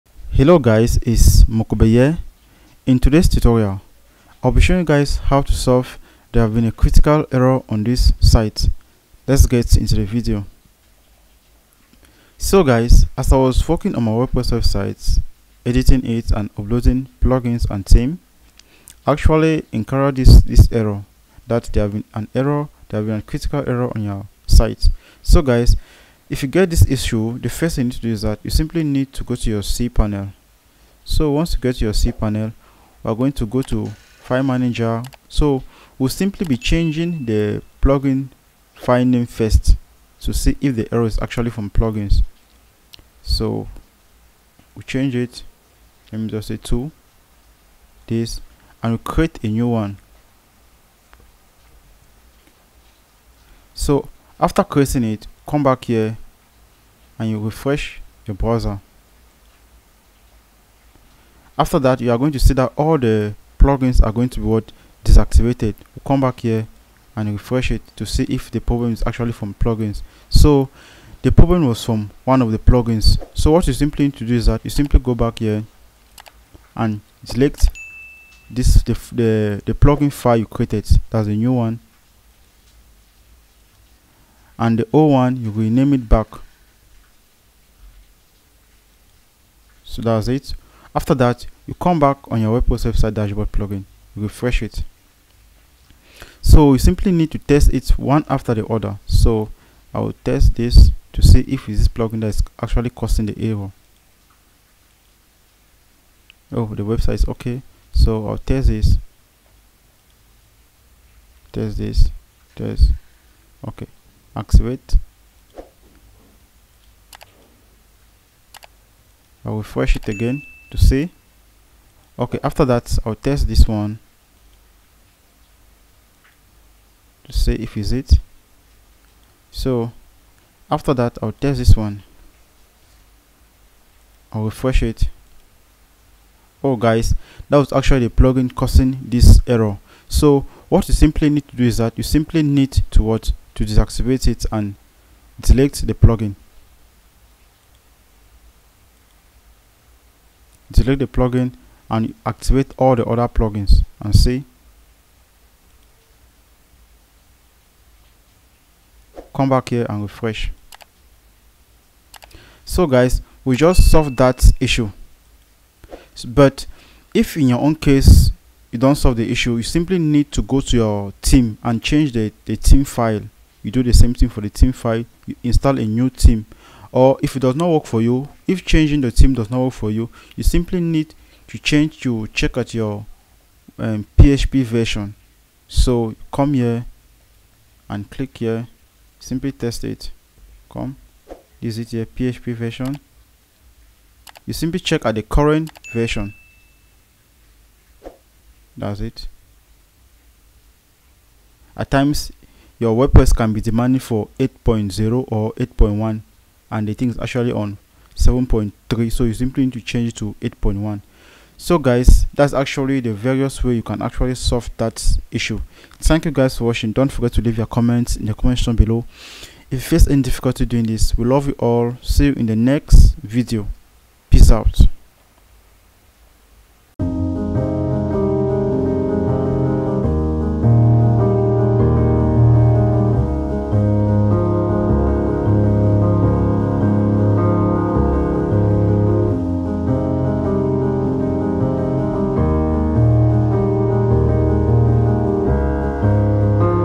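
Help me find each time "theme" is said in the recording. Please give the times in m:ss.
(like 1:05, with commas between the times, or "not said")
0:17, 2:59.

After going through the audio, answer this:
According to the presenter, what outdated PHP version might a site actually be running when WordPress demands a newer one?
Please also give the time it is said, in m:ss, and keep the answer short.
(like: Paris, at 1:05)
7.3, at 3:28.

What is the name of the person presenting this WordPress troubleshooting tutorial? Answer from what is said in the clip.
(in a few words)
Mokube.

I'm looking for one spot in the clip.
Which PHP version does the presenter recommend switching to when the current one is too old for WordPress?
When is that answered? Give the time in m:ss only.
3:29.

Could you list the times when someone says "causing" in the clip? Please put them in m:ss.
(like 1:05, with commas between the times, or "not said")
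1:42, 2:18.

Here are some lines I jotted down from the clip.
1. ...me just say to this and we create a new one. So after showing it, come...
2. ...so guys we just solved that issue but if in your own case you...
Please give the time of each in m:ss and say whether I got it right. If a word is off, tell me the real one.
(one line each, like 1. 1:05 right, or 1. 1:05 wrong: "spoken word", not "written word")
1. 0:46 wrong: "creating", not "showing"
2. 2:42 right.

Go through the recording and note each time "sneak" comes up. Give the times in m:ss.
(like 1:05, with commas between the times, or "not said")
not said.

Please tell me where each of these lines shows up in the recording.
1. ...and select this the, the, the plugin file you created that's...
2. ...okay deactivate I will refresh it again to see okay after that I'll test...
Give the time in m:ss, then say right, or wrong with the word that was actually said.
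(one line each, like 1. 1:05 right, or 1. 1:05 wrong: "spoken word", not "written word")
1. 1:16 right
2. 1:53 wrong: "activate", not "deactivate".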